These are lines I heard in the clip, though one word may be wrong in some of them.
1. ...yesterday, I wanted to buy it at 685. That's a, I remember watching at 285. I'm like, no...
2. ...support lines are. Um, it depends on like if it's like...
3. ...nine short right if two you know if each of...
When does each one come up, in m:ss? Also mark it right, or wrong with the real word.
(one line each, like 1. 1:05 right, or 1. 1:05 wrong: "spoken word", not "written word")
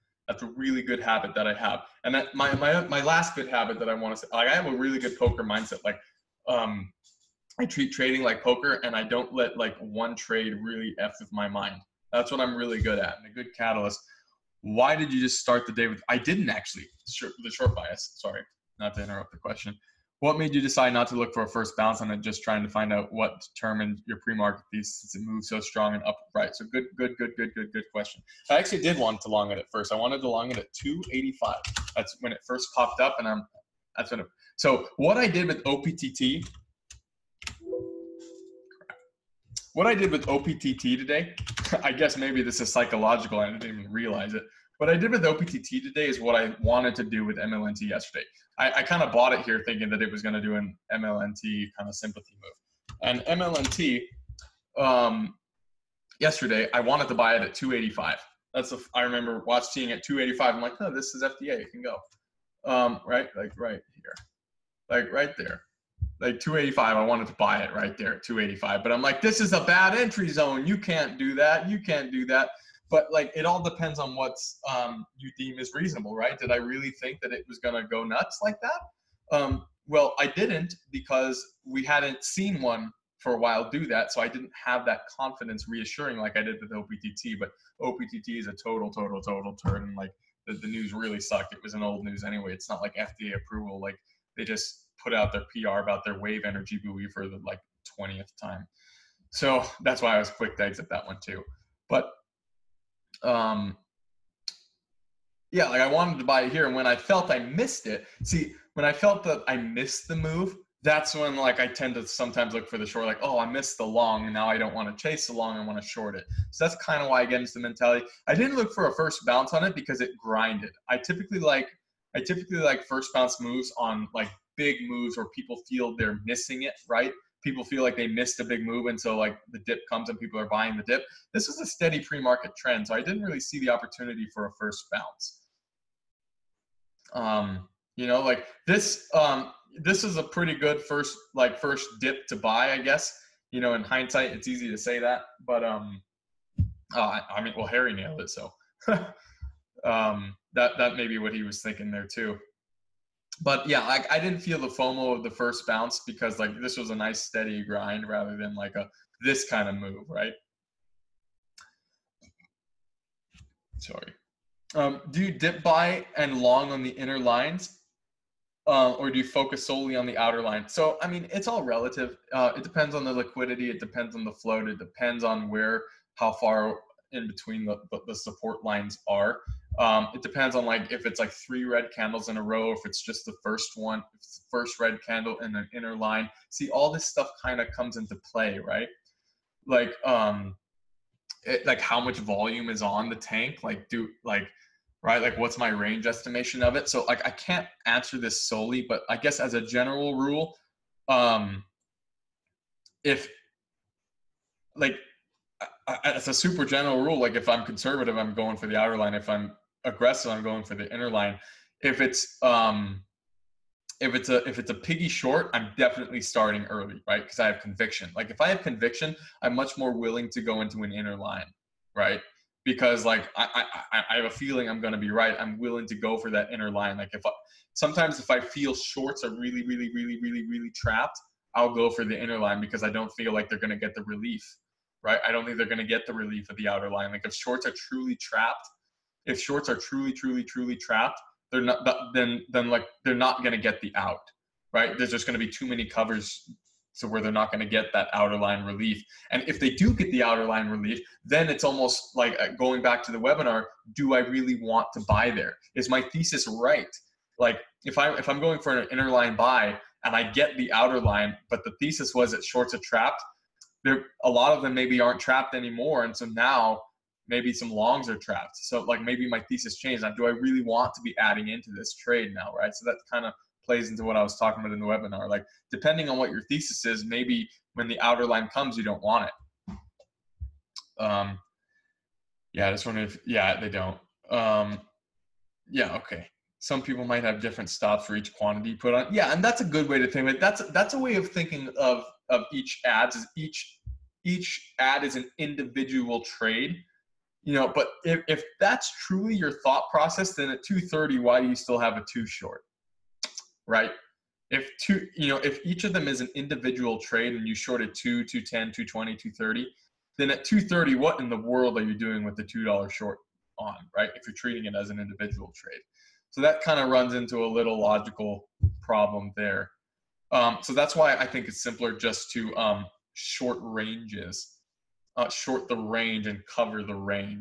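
1. 0:56 wrong: "285", not "685"
2. 2:58 right
3. 5:02 wrong: "two", not "nine".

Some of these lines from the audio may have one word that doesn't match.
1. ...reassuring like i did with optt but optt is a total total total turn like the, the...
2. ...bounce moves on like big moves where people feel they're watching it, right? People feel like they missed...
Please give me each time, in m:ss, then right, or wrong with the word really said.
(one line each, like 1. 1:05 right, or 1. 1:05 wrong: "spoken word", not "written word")
1. 1:25 right
2. 2:03 wrong: "missing", not "watching".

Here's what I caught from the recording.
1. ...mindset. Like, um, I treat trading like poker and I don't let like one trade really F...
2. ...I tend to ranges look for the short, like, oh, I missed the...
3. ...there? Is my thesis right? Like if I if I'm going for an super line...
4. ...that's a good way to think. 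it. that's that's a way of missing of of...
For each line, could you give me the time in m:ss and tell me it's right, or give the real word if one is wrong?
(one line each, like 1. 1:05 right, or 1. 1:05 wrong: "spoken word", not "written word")
1. 0:05 right
2. 1:51 wrong: "sometimes", not "ranges"
3. 4:15 wrong: "inner", not "super"
4. 4:49 wrong: "thinking", not "missing".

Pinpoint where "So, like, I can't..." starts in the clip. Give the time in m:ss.
3:16.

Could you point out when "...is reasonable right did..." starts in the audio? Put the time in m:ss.
1:15.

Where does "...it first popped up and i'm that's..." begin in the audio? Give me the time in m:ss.
0:32.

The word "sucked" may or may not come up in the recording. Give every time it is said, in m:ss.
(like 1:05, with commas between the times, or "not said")
1:31.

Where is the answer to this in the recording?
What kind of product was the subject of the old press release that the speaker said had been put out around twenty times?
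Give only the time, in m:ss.
1:36.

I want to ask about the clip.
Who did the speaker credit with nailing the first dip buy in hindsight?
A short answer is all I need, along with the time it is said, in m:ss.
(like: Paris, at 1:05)
Harry, at 2:27.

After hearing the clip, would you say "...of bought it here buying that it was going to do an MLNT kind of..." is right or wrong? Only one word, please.
wrong.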